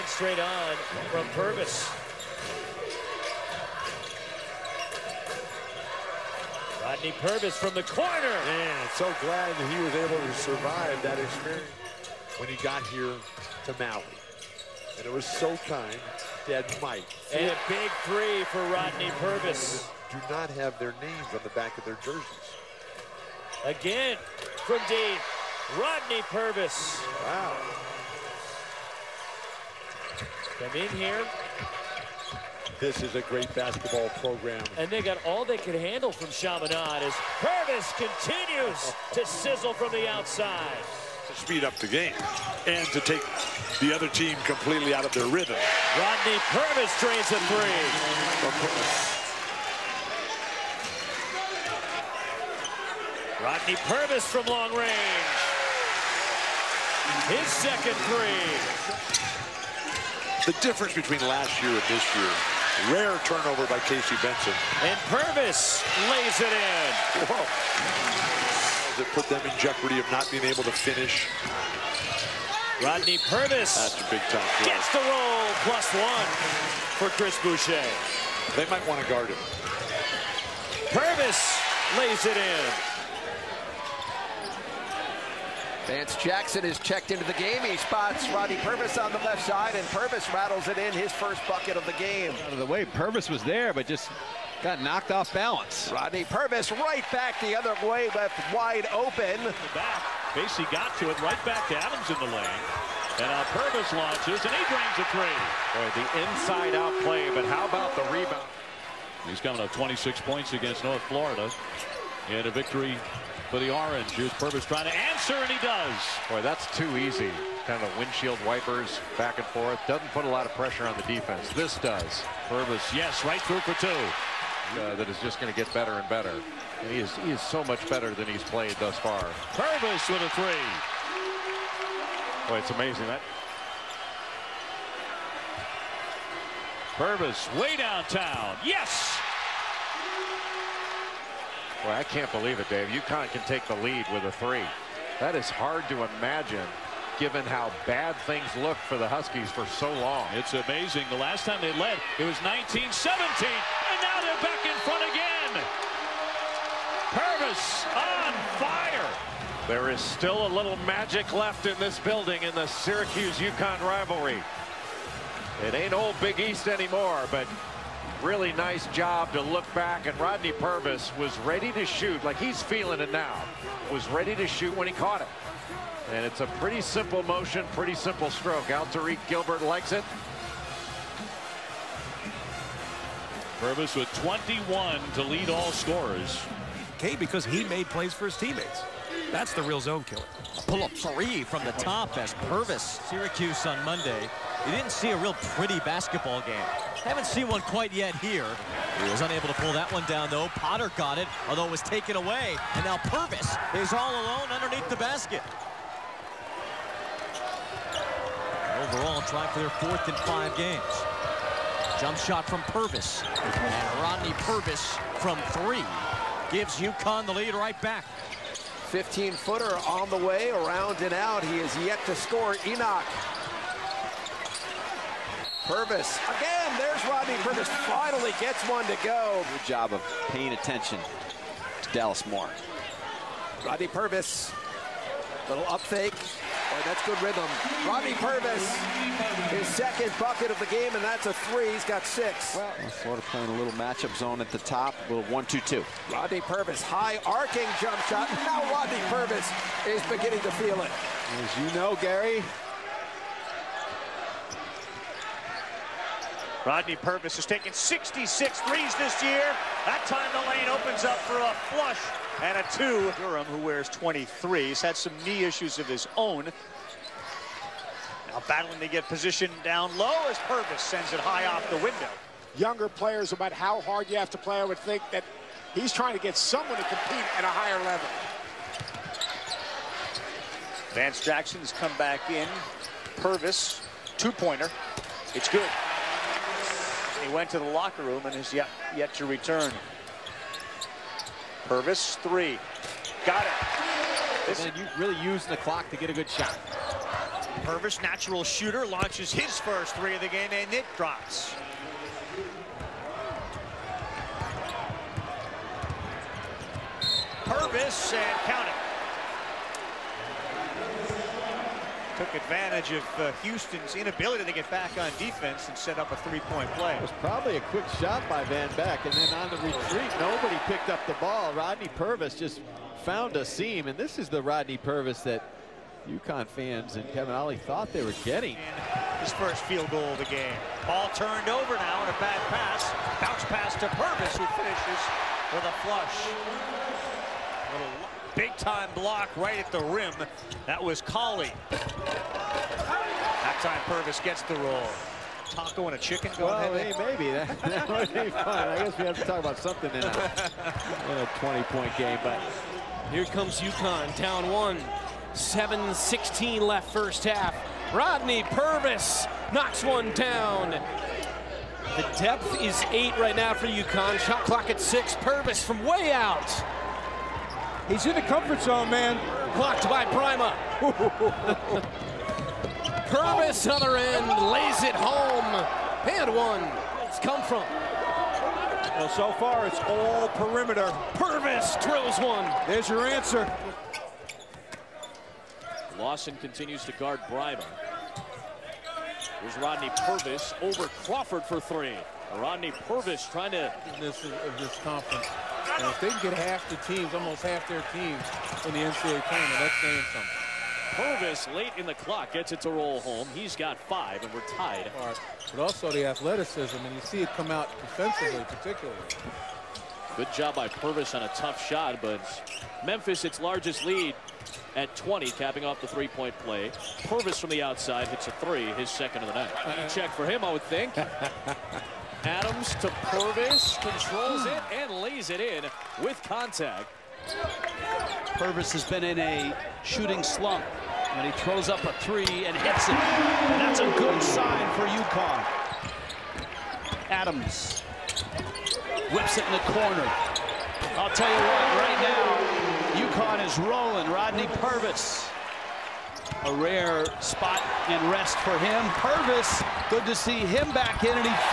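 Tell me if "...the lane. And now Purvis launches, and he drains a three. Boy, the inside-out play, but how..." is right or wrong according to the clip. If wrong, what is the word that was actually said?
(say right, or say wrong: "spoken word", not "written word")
right.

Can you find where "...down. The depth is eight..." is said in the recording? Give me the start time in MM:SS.
06:00.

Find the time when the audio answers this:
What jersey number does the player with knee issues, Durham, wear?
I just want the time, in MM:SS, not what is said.
04:23.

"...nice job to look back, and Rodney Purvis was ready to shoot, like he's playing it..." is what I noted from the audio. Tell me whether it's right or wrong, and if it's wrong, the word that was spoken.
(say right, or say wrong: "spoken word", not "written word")
wrong: "feeling", not "playing".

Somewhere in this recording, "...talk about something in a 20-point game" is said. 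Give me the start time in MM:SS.
05:49.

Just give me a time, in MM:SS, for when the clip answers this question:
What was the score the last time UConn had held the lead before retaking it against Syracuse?
02:32.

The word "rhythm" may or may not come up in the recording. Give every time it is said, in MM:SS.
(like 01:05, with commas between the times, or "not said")
00:45, 03:57.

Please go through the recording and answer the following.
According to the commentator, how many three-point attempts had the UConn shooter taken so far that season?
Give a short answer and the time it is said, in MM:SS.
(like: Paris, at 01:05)
66, at 04:17.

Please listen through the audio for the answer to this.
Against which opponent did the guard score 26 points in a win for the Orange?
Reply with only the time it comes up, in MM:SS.
01:50.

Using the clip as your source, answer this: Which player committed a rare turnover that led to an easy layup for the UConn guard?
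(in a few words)
Casey Benson.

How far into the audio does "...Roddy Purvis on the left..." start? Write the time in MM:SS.
01:28.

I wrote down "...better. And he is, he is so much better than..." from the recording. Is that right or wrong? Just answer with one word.
right.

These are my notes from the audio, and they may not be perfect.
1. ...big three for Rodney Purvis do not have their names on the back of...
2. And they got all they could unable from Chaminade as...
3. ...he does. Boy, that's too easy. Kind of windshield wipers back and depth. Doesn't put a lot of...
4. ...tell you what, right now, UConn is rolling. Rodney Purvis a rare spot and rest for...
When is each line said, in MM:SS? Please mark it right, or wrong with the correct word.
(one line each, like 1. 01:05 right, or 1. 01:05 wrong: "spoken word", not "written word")
1. 00:17 right
2. 00:34 wrong: "handle", not "unable"
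3. 01:55 wrong: "forth", not "depth"
4. 07:21 right.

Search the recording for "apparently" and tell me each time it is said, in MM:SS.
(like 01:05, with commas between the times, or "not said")
not said.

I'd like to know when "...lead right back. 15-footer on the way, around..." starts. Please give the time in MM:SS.
03:37.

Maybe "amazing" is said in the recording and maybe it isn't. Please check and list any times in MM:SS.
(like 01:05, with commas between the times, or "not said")
02:12, 02:30.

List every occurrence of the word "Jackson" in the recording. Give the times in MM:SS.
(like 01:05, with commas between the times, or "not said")
01:26, 04:41.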